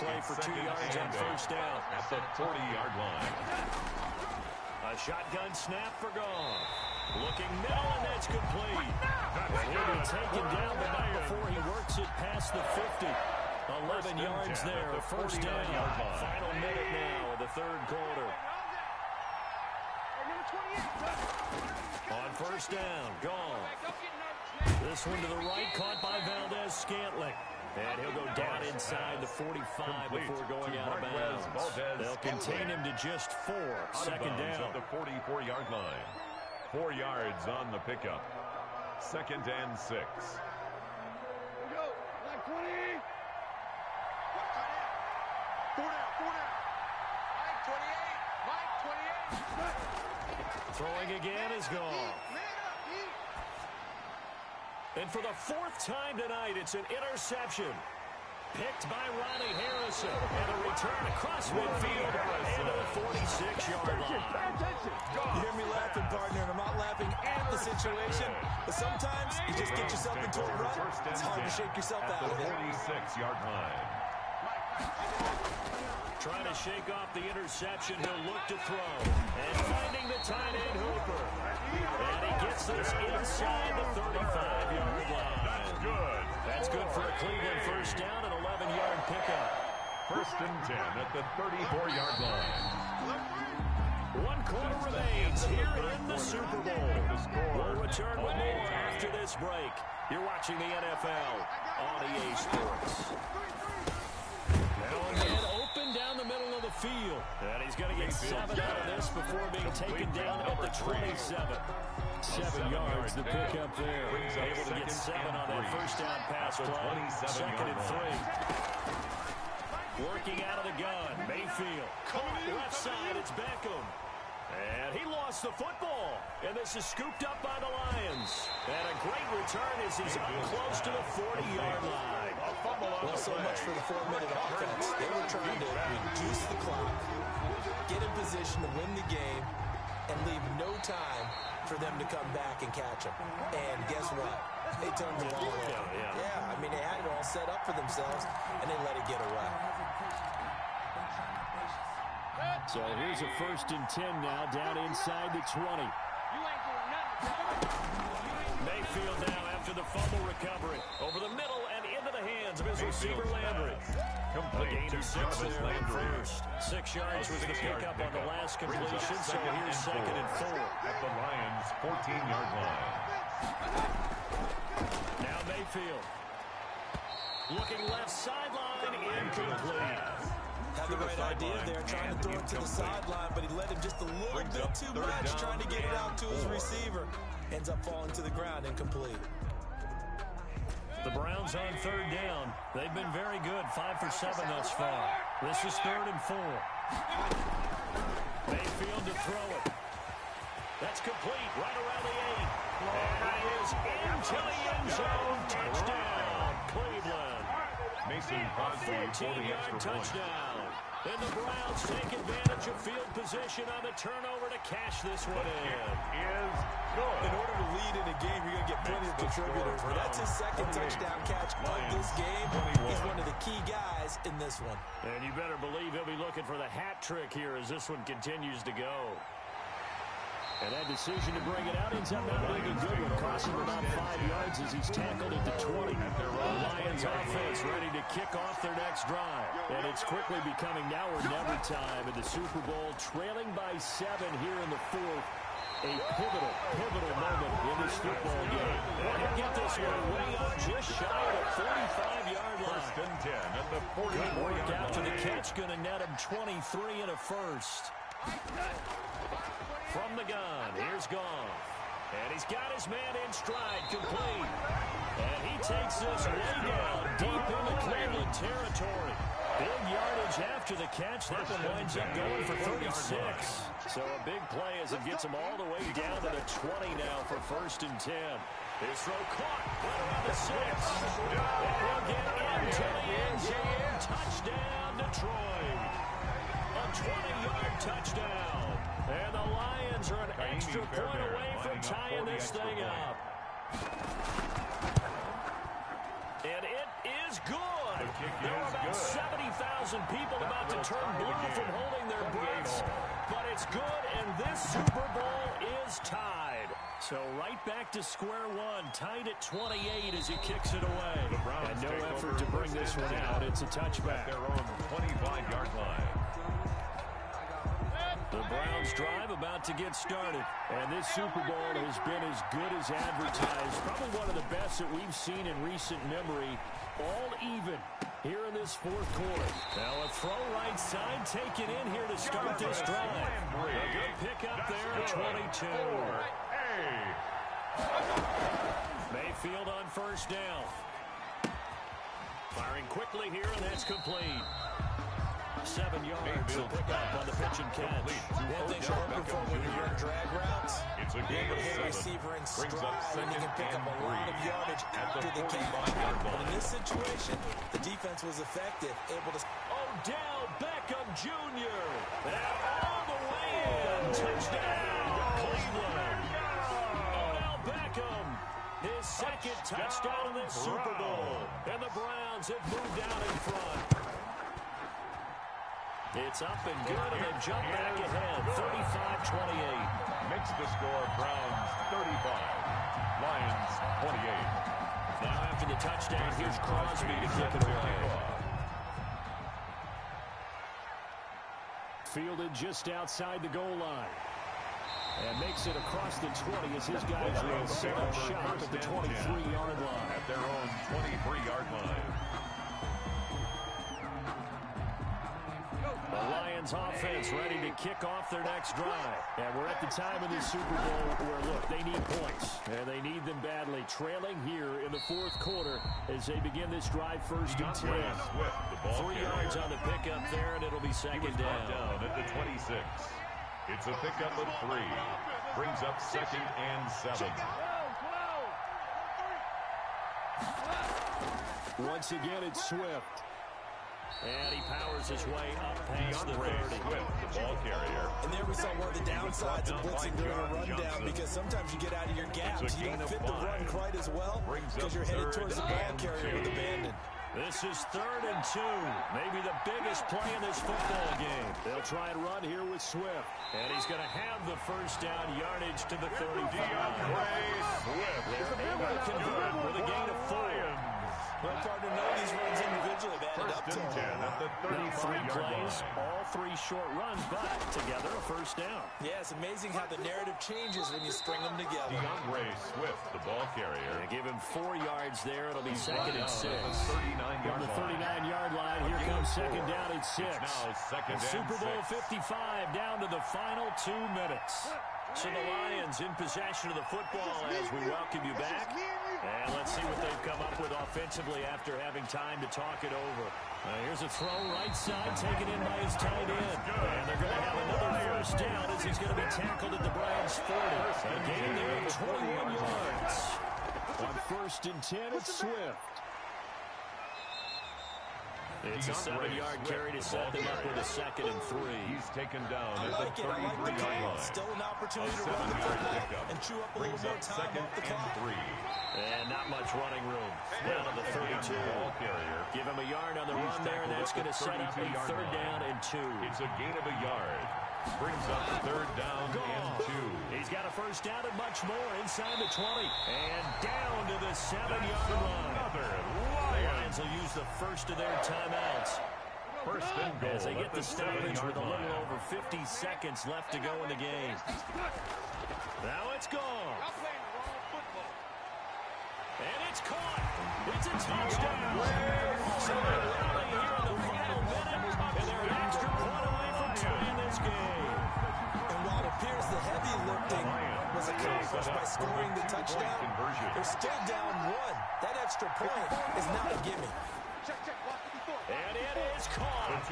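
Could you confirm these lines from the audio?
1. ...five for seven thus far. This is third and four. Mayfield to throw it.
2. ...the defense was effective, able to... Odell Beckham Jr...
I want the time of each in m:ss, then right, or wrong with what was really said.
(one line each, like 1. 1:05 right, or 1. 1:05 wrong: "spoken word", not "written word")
1. 3:13 right
2. 5:57 right.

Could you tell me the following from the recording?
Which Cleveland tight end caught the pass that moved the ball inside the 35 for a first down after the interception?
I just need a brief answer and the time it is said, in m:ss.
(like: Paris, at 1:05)
Hooper, at 1:20.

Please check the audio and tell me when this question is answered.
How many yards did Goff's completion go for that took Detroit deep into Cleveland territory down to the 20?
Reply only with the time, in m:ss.
4:32.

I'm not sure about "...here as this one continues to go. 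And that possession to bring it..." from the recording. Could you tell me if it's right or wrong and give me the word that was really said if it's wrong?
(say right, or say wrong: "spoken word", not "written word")
wrong: "decision", not "possession".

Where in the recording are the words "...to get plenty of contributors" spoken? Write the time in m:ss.
3:38.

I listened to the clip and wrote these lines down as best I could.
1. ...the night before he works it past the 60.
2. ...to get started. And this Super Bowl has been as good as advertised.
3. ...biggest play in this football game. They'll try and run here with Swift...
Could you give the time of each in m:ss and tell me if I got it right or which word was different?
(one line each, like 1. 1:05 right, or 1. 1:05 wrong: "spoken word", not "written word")
1. 0:10 wrong: "50", not "60"
2. 5:19 right
3. 7:29 right.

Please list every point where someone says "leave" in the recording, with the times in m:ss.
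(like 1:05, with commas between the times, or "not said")
2:20.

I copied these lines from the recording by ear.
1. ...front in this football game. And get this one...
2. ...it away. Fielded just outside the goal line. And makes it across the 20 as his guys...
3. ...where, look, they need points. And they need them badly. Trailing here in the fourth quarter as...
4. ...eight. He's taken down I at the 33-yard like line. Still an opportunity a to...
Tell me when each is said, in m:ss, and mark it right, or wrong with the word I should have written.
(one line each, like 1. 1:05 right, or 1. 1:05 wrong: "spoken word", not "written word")
1. 4:07 wrong: "moment", not "front"
2. 6:27 right
3. 6:51 right
4. 8:31 wrong: "three", not "eight".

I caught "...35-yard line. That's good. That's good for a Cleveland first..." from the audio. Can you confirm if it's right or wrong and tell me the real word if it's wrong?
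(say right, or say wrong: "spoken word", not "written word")
right.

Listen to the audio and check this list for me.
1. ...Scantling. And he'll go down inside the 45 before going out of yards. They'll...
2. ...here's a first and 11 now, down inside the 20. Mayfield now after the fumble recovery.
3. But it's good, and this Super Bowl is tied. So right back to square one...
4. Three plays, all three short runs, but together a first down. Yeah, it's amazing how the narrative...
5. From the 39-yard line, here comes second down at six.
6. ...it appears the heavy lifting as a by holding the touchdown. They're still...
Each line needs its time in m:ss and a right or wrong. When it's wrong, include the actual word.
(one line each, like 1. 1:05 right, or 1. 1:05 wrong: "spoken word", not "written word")
1. 0:26 wrong: "bounds", not "yards"
2. 2:33 wrong: "10", not "11"
3. 5:03 right
4. 7:44 right
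5. 7:56 right
6. 9:19 wrong: "scoring", not "holding".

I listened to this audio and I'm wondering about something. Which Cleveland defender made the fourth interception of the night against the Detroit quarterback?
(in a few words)
Ronnie Harrison.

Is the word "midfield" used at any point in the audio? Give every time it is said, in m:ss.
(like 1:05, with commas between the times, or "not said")
1:01, 1:46.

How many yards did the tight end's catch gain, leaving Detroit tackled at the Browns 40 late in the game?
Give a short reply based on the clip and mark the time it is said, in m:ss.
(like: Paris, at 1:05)
21, at 8:22.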